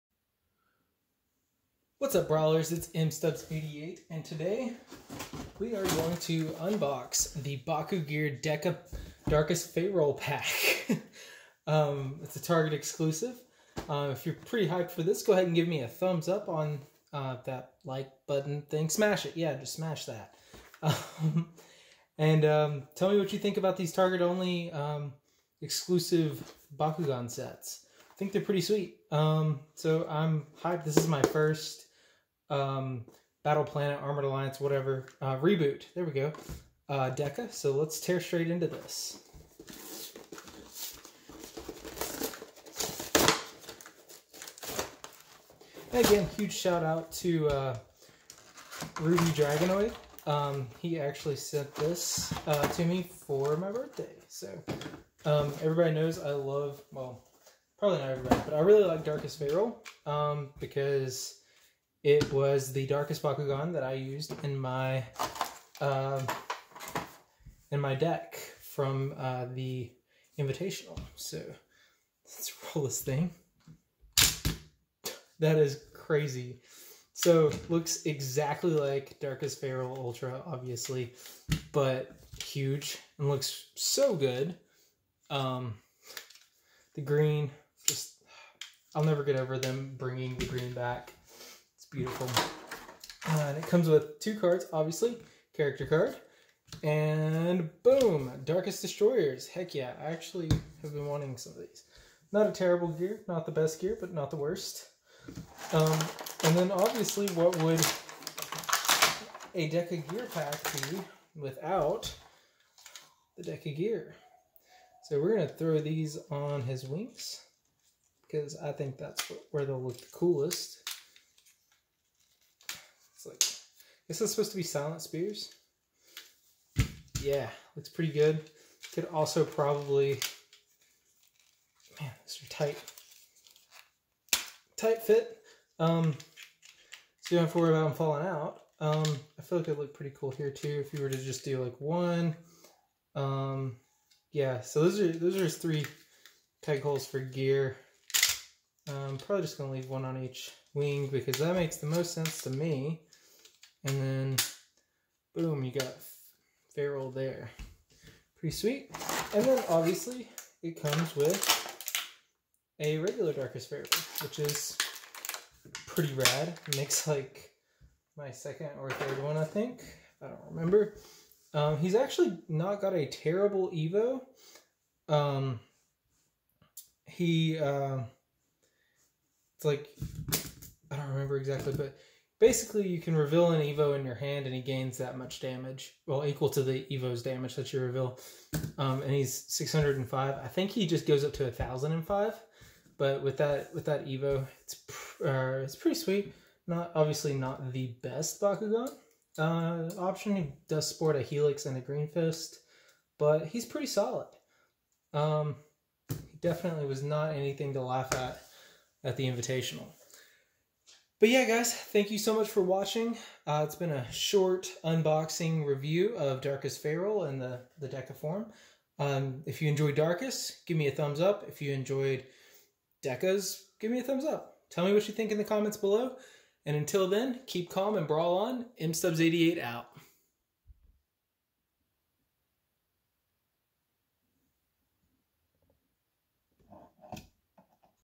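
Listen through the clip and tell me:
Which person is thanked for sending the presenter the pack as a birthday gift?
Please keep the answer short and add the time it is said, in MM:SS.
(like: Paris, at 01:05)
Ruby Dragonoid, at 00:49.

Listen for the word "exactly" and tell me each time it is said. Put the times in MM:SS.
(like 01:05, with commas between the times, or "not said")
01:18, 03:01.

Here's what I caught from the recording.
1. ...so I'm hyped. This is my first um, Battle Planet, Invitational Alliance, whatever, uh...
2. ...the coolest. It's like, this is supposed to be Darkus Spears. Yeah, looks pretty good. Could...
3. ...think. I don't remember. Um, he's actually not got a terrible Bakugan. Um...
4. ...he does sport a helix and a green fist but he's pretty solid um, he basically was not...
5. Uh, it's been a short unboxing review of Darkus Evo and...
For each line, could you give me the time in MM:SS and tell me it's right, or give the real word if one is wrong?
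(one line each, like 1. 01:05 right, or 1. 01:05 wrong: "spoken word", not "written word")
1. 00:29 wrong: "Armored", not "Invitational"
2. 01:59 wrong: "Silent", not "Darkus"
3. 02:49 wrong: "Evo", not "Bakugan"
4. 03:20 wrong: "definitely", not "basically"
5. 03:33 wrong: "Pharol", not "Evo".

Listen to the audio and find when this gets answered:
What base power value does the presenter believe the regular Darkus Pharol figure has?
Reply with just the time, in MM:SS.
03:09.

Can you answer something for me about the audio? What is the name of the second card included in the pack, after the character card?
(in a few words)
Darkest Destroyers.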